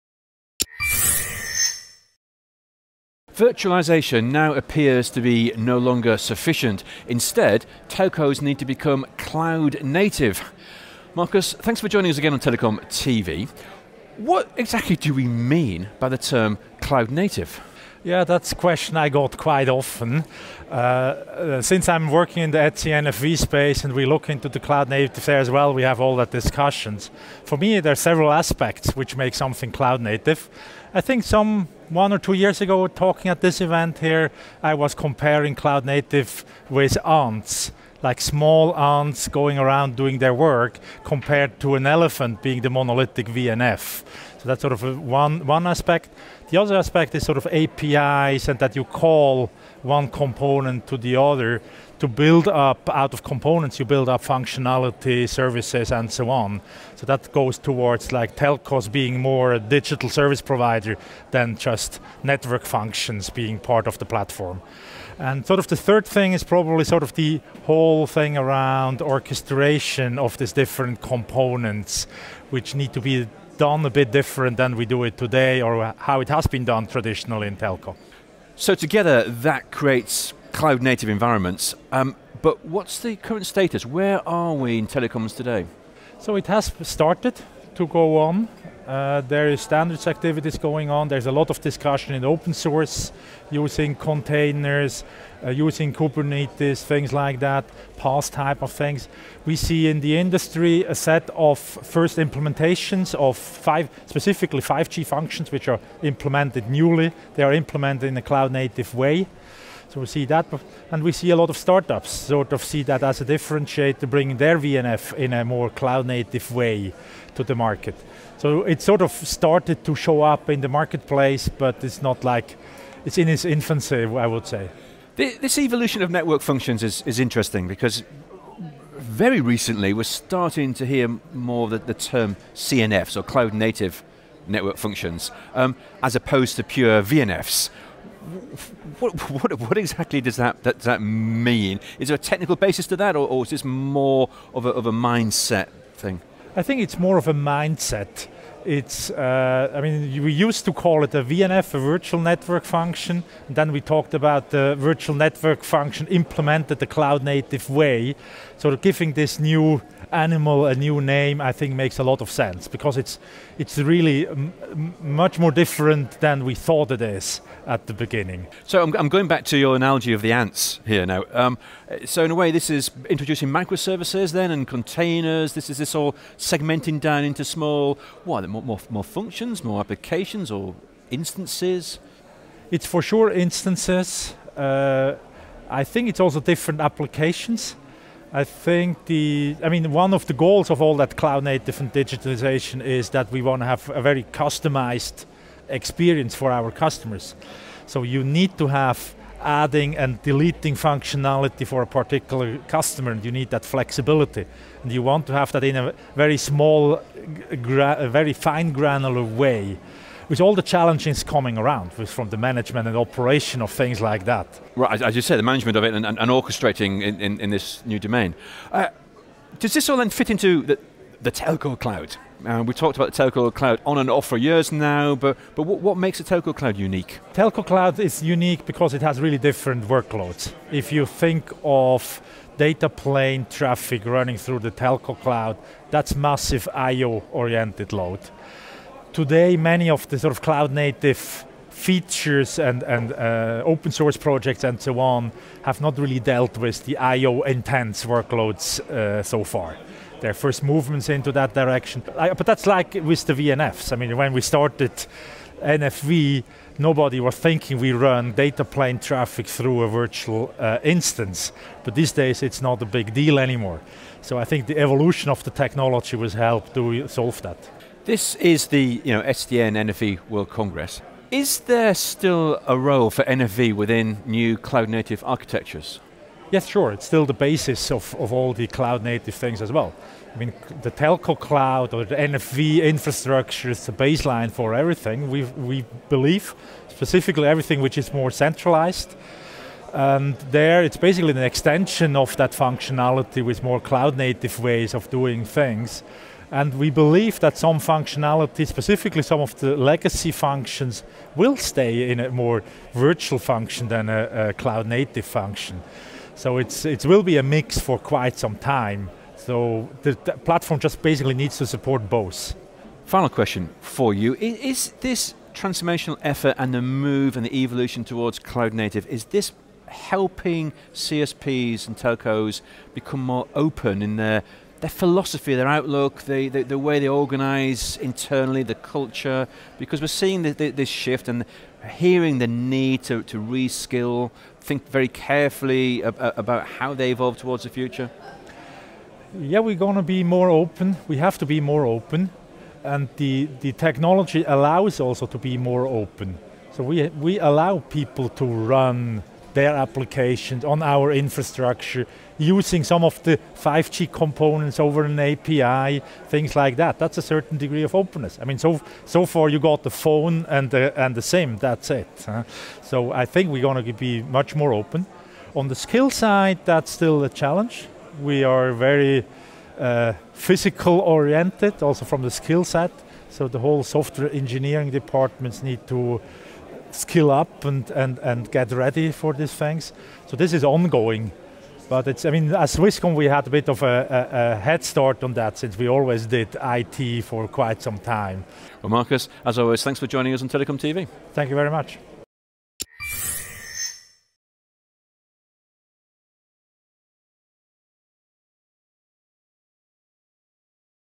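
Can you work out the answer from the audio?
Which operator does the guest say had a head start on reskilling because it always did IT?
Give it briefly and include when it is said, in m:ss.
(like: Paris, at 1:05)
Swisscom, at 6:22.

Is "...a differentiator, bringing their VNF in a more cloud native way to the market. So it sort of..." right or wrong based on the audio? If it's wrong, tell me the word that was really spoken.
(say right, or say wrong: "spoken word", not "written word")
right.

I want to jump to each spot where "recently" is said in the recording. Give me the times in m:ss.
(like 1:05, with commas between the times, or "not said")
2:09.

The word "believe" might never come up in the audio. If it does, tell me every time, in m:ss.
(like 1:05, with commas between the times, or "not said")
4:46, 4:56.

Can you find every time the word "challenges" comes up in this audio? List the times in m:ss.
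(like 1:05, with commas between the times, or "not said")
3:30, 6:07.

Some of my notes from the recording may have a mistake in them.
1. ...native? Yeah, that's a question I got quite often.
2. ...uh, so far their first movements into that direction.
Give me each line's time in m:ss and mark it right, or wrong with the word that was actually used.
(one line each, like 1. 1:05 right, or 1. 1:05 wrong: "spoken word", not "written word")
1. 0:17 right
2. 4:08 right.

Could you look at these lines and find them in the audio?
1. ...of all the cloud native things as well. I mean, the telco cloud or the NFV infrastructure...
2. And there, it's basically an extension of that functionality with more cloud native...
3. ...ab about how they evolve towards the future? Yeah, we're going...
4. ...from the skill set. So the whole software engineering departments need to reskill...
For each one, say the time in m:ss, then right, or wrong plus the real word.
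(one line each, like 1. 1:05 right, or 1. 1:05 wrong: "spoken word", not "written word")
1. 4:38 right
2. 4:49 right
3. 5:36 right
4. 6:12 wrong: "skill", not "reskill".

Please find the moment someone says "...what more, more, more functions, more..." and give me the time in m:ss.
2:58.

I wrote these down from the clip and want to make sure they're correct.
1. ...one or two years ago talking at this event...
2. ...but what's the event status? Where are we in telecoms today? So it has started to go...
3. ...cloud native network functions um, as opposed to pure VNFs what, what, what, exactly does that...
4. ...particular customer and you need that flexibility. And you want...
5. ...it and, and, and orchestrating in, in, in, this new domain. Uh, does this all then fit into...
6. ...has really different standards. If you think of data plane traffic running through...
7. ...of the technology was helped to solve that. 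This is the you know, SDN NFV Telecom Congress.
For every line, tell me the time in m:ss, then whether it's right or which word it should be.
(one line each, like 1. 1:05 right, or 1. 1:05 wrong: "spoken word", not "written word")
1. 0:31 right
2. 1:22 wrong: "current", not "event"
3. 2:13 right
4. 3:21 right
5. 3:35 right
6. 3:49 wrong: "workloads", not "standards"
7. 4:25 wrong: "World", not "Telecom".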